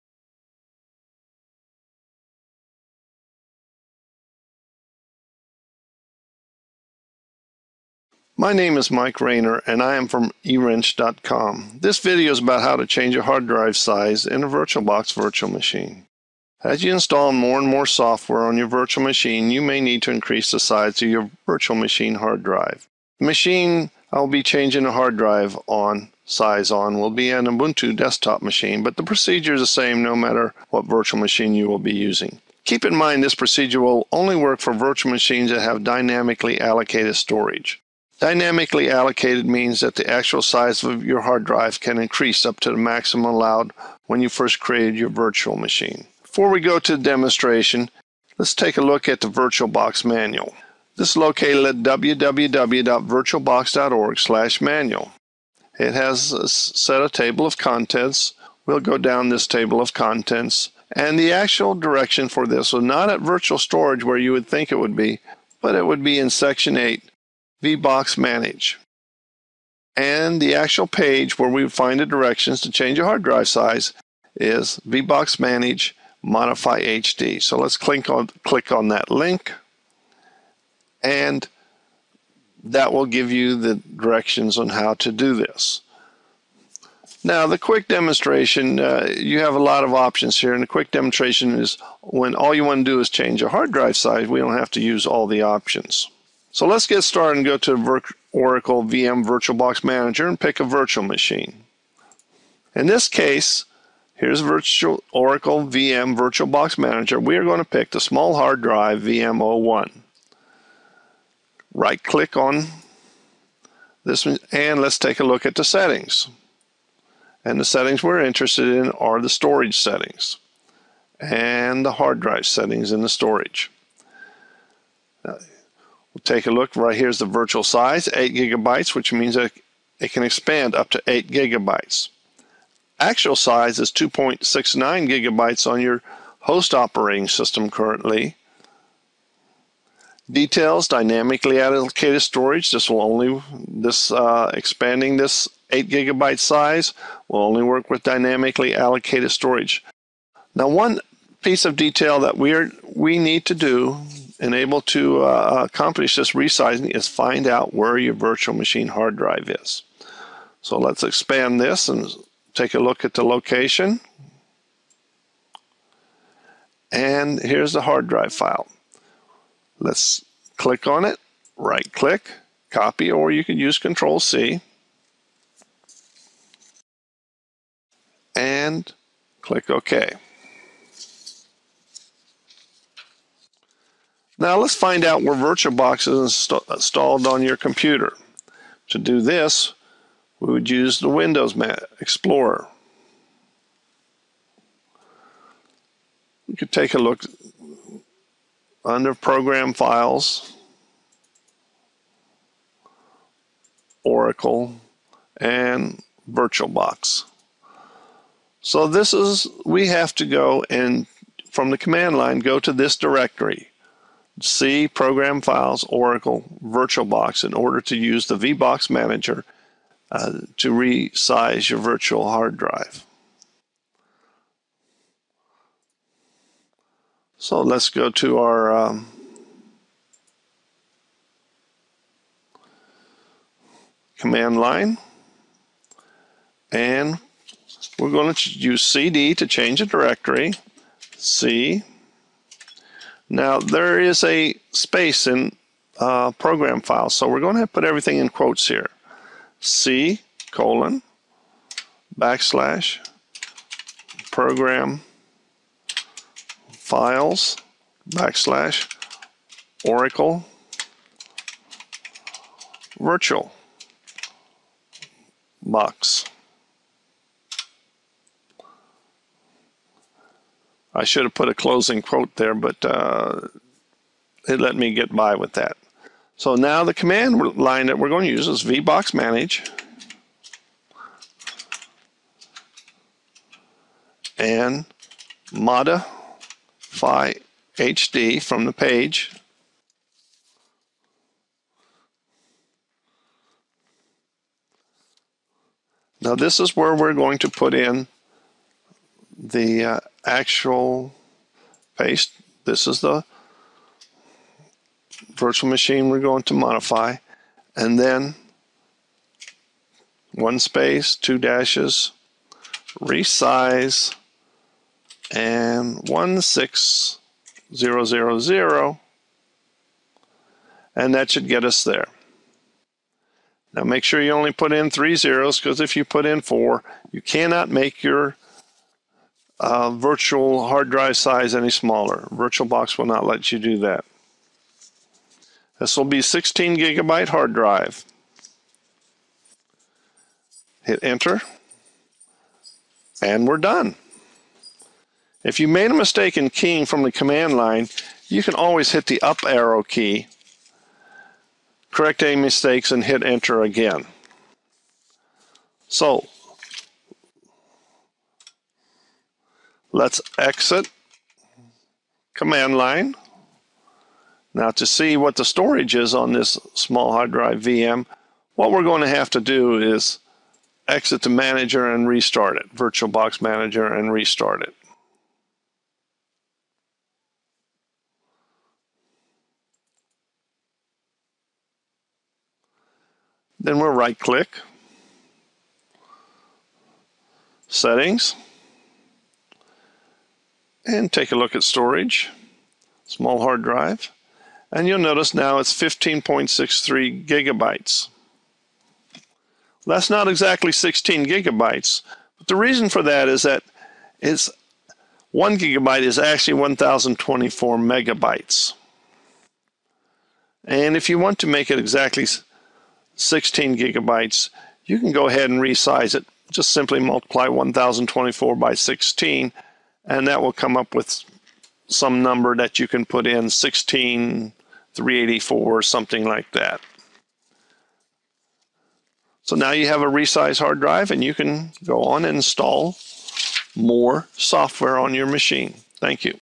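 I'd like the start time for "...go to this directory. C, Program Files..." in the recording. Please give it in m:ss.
3:32.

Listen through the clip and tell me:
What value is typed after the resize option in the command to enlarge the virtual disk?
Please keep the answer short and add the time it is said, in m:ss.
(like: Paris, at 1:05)
16000, at 5:16.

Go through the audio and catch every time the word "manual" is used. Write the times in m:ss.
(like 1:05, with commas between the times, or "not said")
0:50, 0:54.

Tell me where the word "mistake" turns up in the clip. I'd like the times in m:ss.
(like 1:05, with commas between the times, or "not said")
5:45, 5:52.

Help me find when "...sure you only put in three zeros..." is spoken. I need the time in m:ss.
5:24.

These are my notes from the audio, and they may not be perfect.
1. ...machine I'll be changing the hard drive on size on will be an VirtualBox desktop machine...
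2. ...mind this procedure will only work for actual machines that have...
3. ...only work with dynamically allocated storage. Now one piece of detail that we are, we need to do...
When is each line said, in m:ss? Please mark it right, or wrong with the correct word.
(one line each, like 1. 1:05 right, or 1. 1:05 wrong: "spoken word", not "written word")
1. 0:23 wrong: "Ubuntu", not "VirtualBox"
2. 0:32 wrong: "virtual", not "actual"
3. 2:27 right.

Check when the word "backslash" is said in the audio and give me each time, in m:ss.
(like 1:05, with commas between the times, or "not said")
4:12, 4:18.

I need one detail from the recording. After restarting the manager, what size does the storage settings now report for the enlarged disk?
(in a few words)
15.63 gigabytes.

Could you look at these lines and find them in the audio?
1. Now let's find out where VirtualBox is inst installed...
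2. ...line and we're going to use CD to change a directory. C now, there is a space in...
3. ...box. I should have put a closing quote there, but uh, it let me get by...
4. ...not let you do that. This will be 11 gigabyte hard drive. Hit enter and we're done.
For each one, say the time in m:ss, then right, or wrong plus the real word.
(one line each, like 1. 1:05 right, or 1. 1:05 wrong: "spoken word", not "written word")
1. 3:04 right
2. 3:54 right
3. 4:25 right
4. 5:33 wrong: "16", not "11".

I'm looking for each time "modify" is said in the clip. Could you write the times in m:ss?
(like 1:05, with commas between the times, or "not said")
1:16, 4:45, 5:06.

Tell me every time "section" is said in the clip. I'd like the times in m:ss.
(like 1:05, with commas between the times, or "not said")
1:06.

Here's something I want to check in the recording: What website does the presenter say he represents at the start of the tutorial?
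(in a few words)
eWrench.com.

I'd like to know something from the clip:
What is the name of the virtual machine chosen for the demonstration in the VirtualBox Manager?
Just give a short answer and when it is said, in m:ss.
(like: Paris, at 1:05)
small hard drive VM01, at 1:48.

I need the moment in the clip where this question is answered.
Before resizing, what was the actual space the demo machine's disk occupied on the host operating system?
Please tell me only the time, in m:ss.
2:13.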